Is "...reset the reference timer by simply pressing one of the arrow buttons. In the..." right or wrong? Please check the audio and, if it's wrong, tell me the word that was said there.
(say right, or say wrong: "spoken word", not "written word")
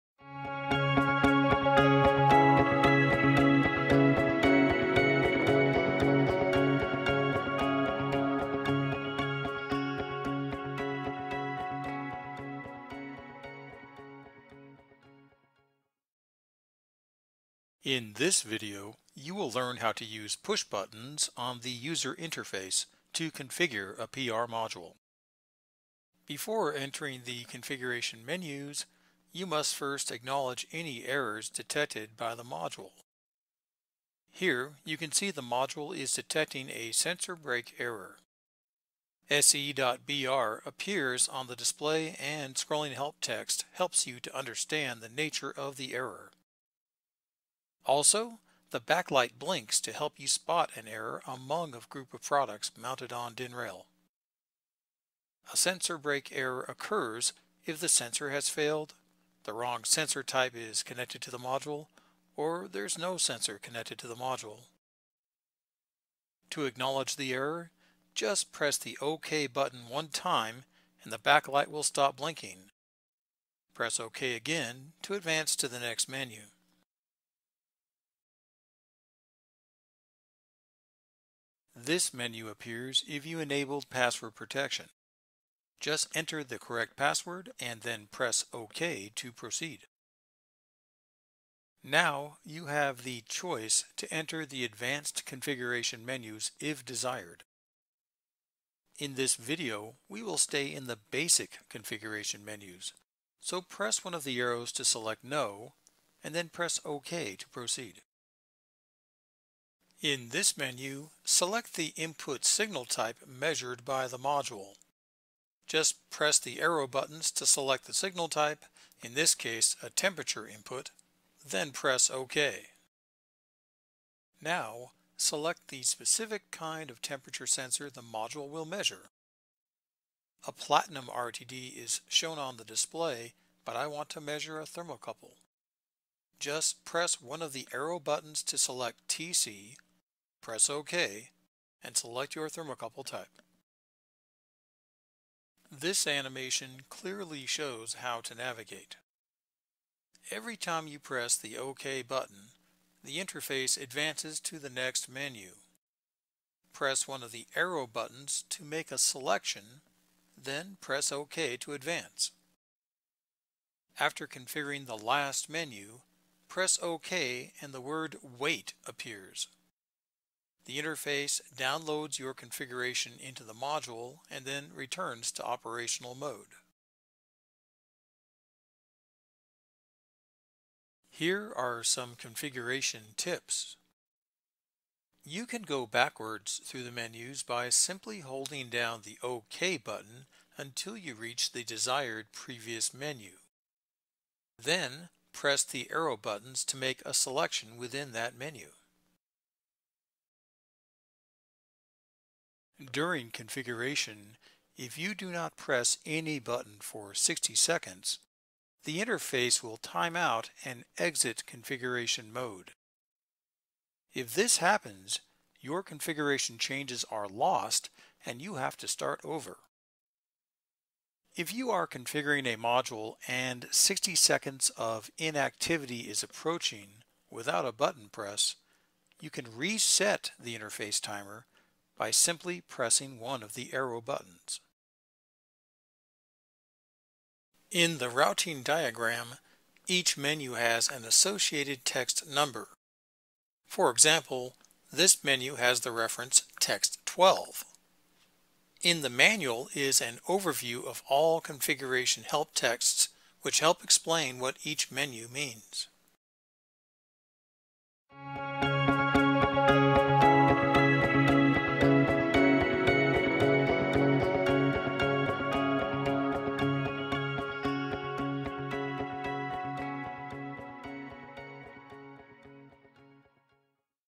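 wrong: "interface", not "reference".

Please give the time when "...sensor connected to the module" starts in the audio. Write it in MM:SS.
01:03.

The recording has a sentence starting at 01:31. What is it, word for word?
Now you have the choice to enter the advanced configuration menus if desired.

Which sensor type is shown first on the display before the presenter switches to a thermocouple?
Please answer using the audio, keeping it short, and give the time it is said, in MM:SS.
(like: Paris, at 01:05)
platinum RTD, at 02:10.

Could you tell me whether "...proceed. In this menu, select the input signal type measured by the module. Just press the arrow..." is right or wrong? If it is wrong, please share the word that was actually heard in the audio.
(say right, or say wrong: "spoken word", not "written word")
right.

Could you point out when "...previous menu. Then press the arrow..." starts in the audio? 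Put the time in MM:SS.
03:12.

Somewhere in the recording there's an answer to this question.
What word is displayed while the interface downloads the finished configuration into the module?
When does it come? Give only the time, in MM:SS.
02:48.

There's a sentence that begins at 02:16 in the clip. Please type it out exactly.
Just press one of the arrow buttons to select TC Press OK and select your thermocouple type.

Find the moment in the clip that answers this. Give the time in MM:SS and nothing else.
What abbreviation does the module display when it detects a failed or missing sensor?
00:39.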